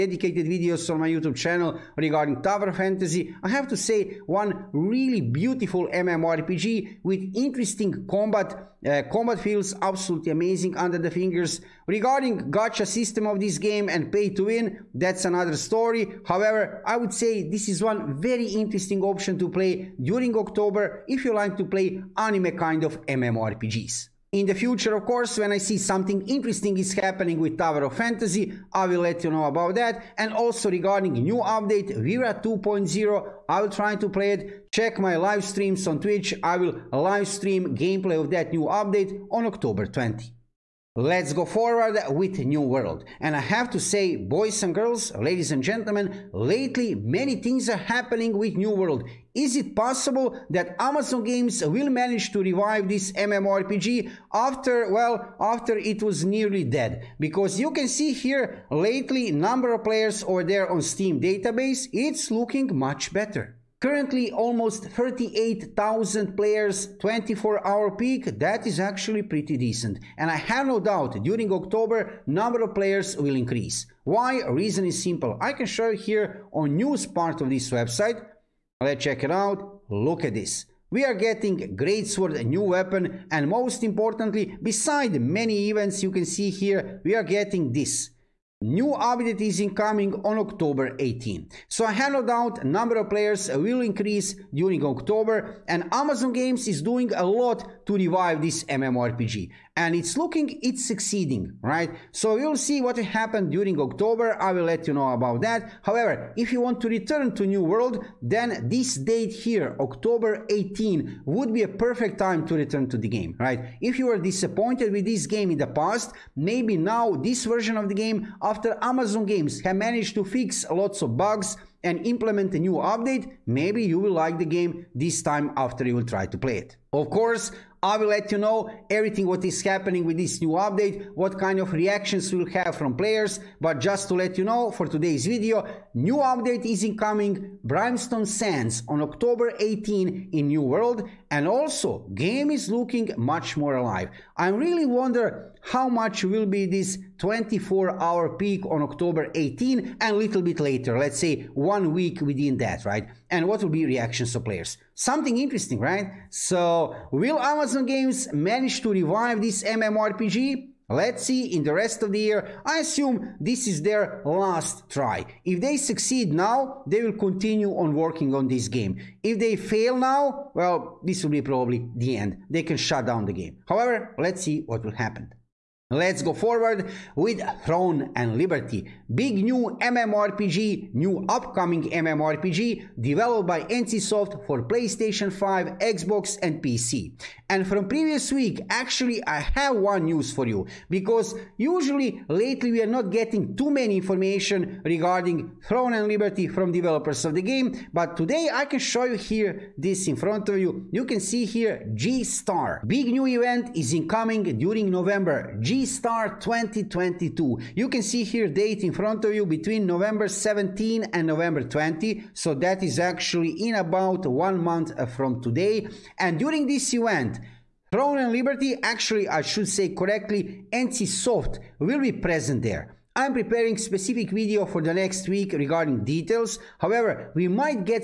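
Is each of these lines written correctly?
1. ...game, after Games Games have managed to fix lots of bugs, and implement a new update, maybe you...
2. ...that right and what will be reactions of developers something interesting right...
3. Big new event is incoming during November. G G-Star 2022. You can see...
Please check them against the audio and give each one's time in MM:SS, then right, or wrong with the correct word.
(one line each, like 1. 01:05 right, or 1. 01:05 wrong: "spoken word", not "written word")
1. 01:57 wrong: "Amazon", not "Games"
2. 02:32 wrong: "players", not "developers"
3. 03:22 right.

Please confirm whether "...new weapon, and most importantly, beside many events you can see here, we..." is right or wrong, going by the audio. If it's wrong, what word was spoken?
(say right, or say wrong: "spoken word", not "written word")
right.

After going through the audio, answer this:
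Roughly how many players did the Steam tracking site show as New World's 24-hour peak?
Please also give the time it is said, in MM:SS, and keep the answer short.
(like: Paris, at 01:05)
38,000, at 01:04.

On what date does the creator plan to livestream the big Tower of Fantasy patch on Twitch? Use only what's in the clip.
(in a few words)
October 20.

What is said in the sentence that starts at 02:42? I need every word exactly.
I assume this is their last try.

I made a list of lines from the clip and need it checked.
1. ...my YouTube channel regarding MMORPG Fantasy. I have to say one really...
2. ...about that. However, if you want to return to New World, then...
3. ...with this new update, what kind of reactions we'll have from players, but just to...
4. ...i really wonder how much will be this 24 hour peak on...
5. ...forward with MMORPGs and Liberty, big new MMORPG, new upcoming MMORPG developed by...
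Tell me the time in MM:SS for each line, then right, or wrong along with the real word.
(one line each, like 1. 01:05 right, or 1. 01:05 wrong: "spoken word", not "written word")
1. 00:01 wrong: "Tower", not "MMORPG"
2. 01:45 right
3. 02:10 right
4. 02:24 right
5. 02:56 wrong: "Throne", not "MMORPGs".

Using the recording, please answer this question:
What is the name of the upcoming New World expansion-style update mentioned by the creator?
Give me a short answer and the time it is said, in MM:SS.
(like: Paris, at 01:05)
Brimstone Sands, at 02:17.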